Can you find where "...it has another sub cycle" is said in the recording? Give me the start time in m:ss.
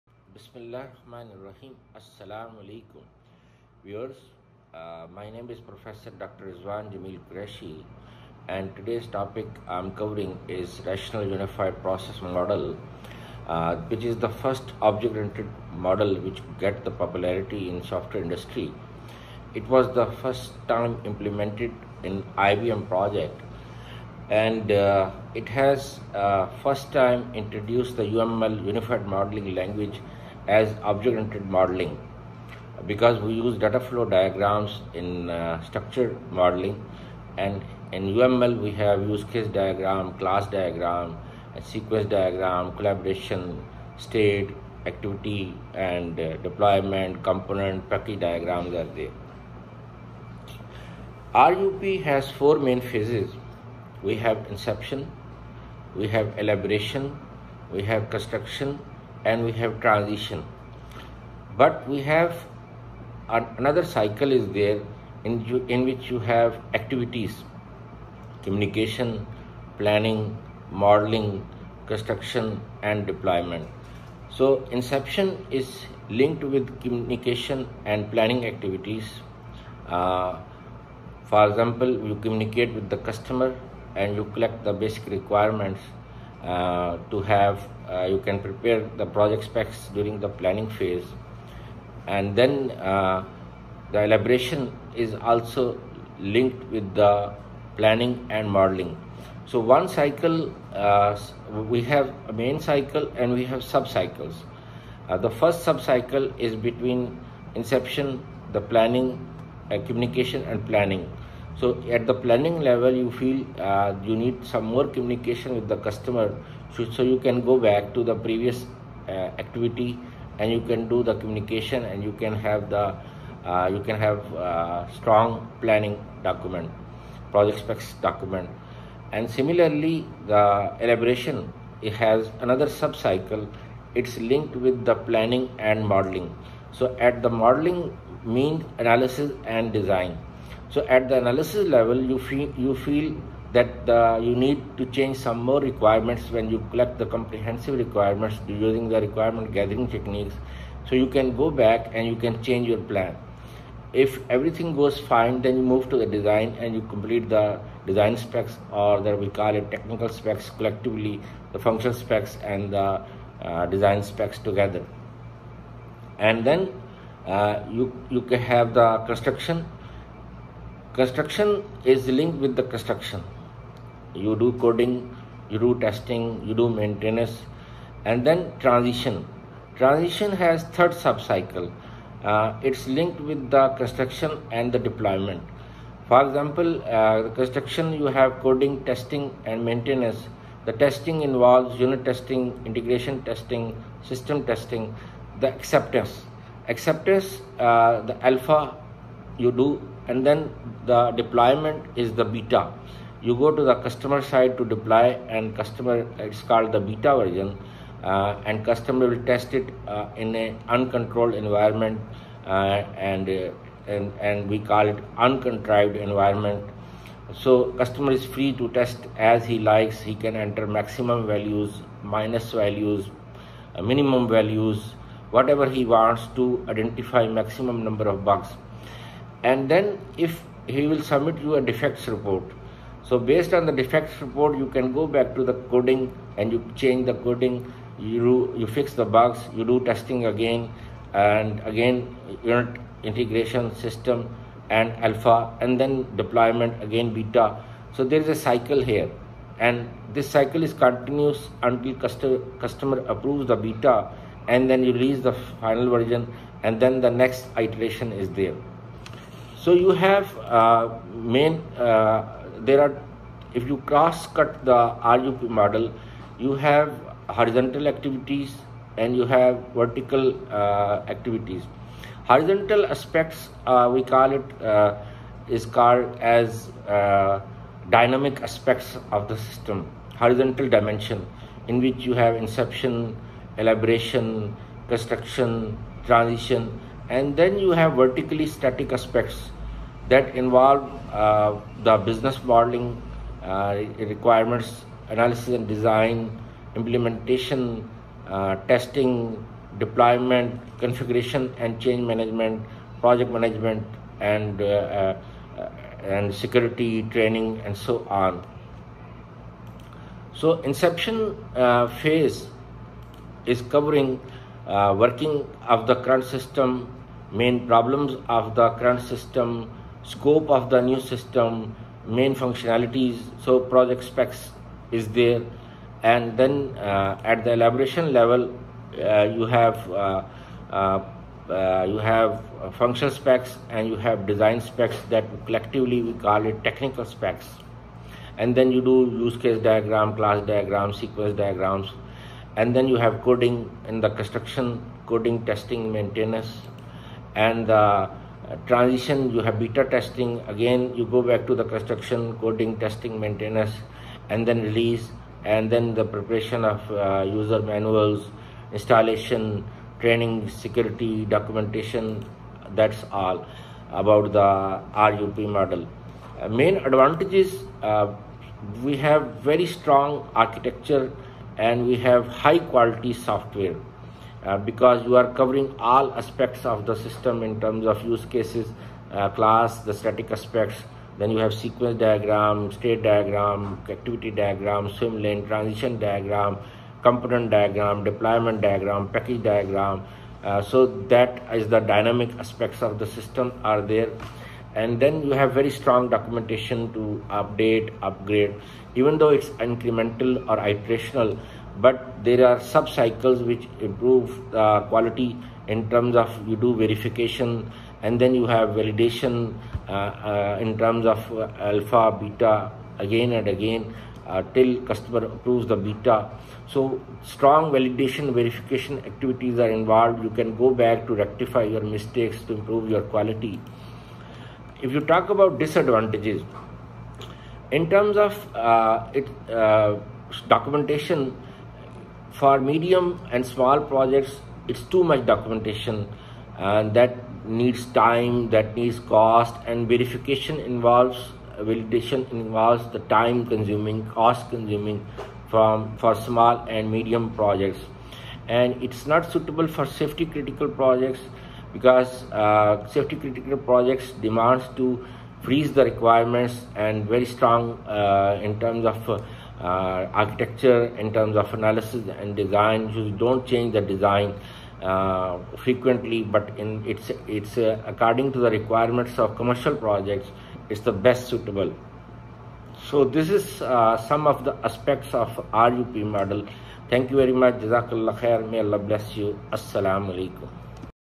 2:11.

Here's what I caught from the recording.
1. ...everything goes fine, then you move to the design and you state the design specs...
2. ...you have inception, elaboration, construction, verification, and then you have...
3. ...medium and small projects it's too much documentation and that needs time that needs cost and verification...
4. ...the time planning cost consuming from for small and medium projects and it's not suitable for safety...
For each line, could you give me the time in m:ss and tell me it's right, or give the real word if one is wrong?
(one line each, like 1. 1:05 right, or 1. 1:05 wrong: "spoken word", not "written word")
1. 2:34 wrong: "complete", not "state"
2. 4:41 wrong: "transition", not "verification"
3. 7:12 right
4. 7:22 wrong: "consuming", not "planning".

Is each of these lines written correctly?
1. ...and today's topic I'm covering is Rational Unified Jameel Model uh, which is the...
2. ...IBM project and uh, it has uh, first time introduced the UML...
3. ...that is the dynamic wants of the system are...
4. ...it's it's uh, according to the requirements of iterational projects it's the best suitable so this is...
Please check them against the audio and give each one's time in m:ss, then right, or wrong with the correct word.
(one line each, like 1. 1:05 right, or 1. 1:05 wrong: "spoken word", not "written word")
1. 0:08 wrong: "Process", not "Jameel"
2. 0:22 right
3. 6:31 wrong: "aspects", not "wants"
4. 7:46 wrong: "commercial", not "iterational".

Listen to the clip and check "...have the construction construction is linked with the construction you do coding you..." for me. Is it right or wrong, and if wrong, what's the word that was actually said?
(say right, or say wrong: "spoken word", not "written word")
right.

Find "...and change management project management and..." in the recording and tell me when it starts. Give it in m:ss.
5:01.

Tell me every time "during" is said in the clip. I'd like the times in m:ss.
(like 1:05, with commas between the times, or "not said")
1:29.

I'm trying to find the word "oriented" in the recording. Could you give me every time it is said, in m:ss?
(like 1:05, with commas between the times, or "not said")
0:14, 0:30.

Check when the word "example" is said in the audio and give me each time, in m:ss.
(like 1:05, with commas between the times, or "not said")
1:21, 3:06.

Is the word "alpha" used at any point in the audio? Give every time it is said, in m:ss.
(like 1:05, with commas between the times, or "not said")
3:18, 4:05, 6:51.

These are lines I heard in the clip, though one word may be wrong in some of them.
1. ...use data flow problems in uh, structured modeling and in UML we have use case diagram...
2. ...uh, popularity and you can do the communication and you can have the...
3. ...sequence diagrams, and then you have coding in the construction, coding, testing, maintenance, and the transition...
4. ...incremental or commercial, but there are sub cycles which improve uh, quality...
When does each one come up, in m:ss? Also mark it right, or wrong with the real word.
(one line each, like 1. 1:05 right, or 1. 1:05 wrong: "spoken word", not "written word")
1. 0:33 wrong: "diagrams", not "problems"
2. 1:59 wrong: "activity", not "popularity"
3. 5:40 right
4. 6:39 wrong: "iterational", not "commercial".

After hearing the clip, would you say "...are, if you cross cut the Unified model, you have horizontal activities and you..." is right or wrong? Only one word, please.
wrong.